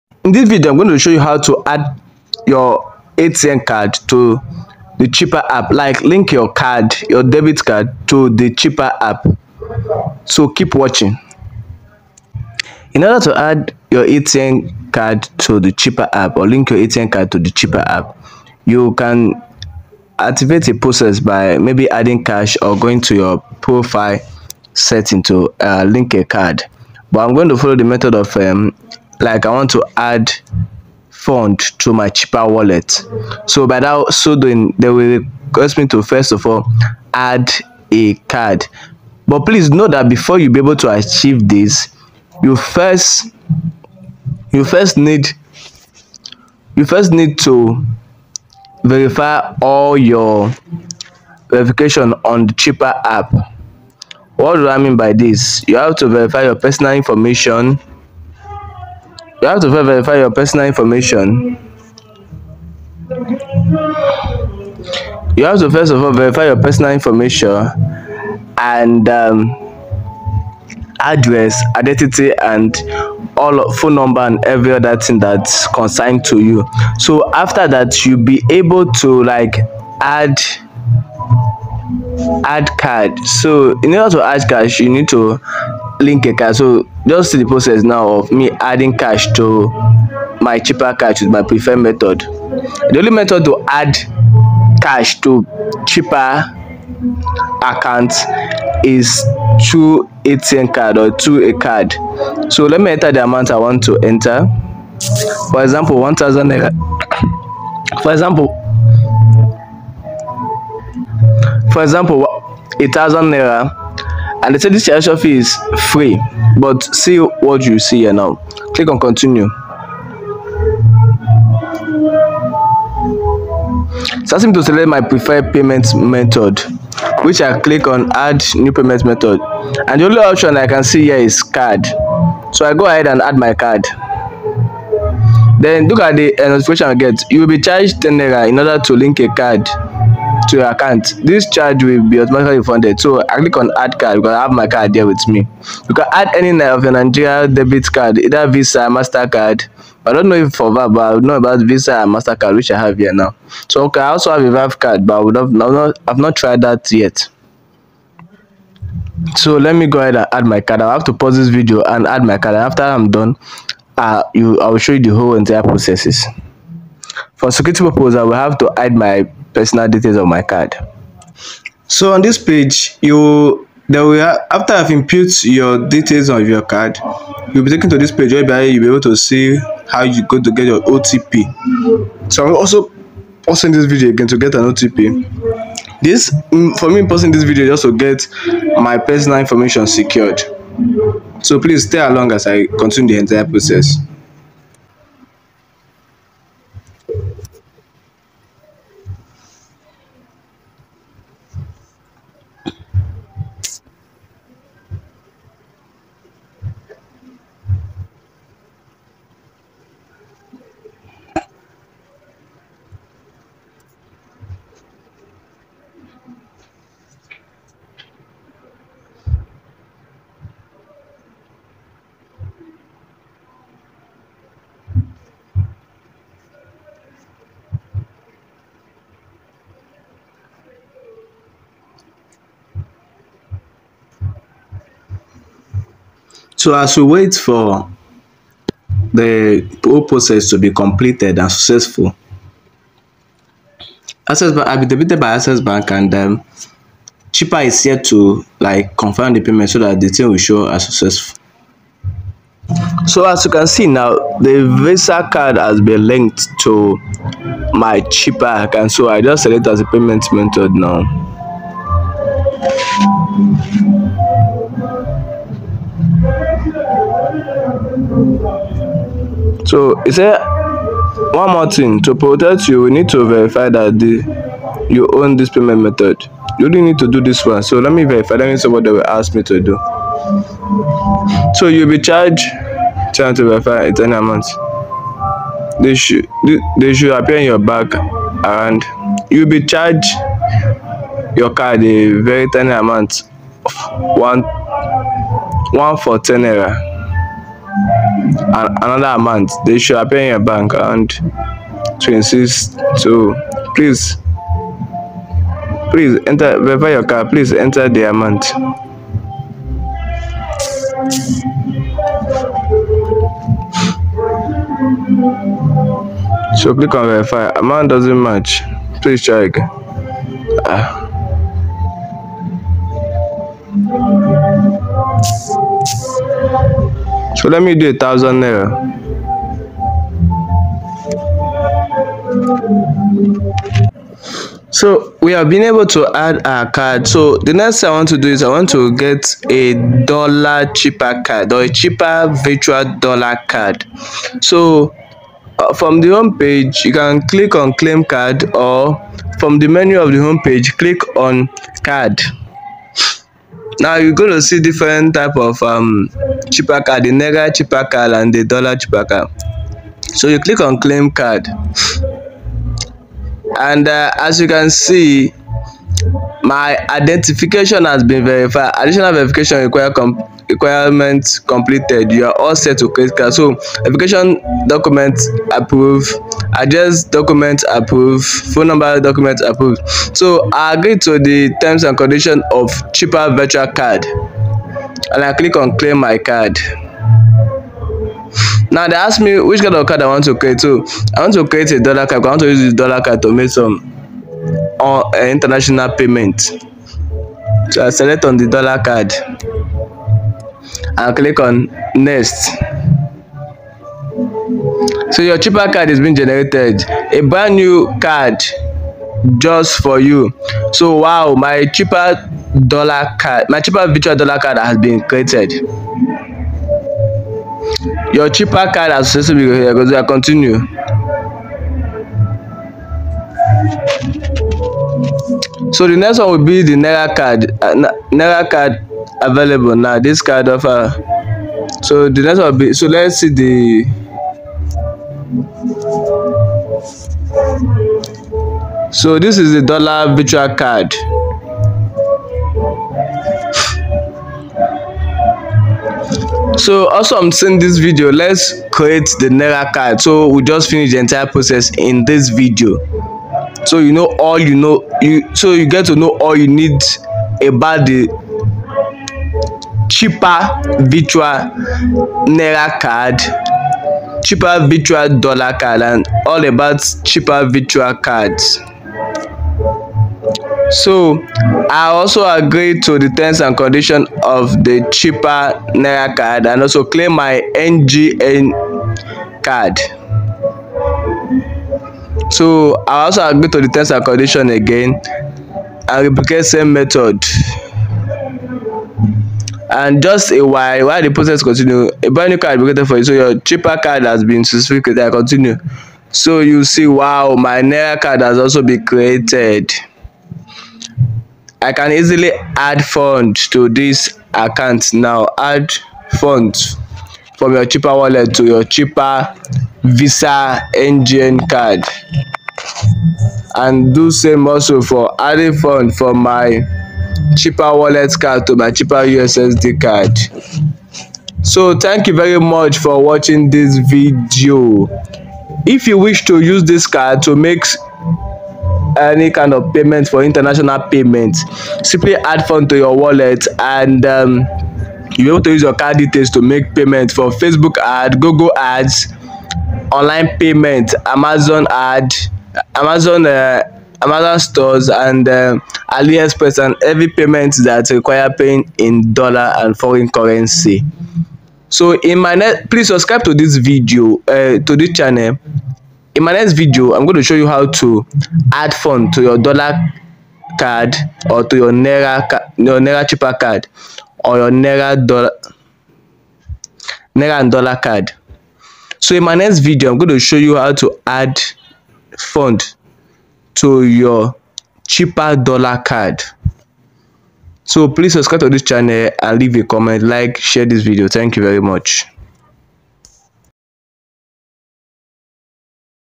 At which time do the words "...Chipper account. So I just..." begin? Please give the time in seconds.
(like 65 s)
258 s.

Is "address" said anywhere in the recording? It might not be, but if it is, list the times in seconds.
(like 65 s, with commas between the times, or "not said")
70 s, 376 s.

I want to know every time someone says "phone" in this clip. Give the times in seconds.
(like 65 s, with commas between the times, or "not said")
73 s, 378 s.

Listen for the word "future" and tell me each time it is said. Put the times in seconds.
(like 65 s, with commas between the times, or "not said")
not said.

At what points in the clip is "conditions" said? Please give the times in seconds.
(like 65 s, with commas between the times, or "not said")
381 s, 473 s, 484 s.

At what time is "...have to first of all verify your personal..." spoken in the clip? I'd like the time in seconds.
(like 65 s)
65 s.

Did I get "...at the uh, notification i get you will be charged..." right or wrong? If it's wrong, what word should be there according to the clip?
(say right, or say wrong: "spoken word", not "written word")
right.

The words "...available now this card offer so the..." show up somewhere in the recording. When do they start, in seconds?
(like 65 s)
429 s.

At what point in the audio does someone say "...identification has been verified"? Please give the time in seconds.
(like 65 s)
366 s.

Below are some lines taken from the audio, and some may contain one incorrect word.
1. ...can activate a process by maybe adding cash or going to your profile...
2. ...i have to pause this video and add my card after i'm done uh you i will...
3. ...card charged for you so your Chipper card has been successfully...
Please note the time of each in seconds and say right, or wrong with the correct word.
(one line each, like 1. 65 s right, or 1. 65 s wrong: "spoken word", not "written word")
1. 18 s right
2. 160 s right
3. 492 s wrong: "created", not "charged".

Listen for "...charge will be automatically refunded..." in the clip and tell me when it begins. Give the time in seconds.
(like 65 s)
141 s.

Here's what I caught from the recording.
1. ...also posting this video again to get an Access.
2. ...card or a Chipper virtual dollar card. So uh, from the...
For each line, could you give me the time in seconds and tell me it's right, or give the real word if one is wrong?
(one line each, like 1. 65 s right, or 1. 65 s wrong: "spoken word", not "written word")
1. 182 s wrong: "OTP", not "Access"
2. 341 s right.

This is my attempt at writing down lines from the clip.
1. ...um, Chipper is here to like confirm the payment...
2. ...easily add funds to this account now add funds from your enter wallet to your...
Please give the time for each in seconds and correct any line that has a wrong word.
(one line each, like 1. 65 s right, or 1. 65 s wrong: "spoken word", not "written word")
1. 246 s right
2. 501 s wrong: "cheaper", not "enter".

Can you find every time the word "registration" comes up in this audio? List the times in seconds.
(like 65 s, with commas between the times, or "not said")
114 s.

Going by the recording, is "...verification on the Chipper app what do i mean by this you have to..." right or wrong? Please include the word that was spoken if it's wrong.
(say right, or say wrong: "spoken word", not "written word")
right.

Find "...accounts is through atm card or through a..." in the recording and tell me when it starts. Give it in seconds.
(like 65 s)
97 s.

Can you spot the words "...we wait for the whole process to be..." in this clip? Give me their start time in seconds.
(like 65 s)
236 s.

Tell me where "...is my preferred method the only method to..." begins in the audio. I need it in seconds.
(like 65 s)
91 s.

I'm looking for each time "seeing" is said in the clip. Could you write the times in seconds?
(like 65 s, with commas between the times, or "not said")
447 s.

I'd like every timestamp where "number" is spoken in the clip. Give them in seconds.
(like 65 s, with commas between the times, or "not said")
73 s, 378 s.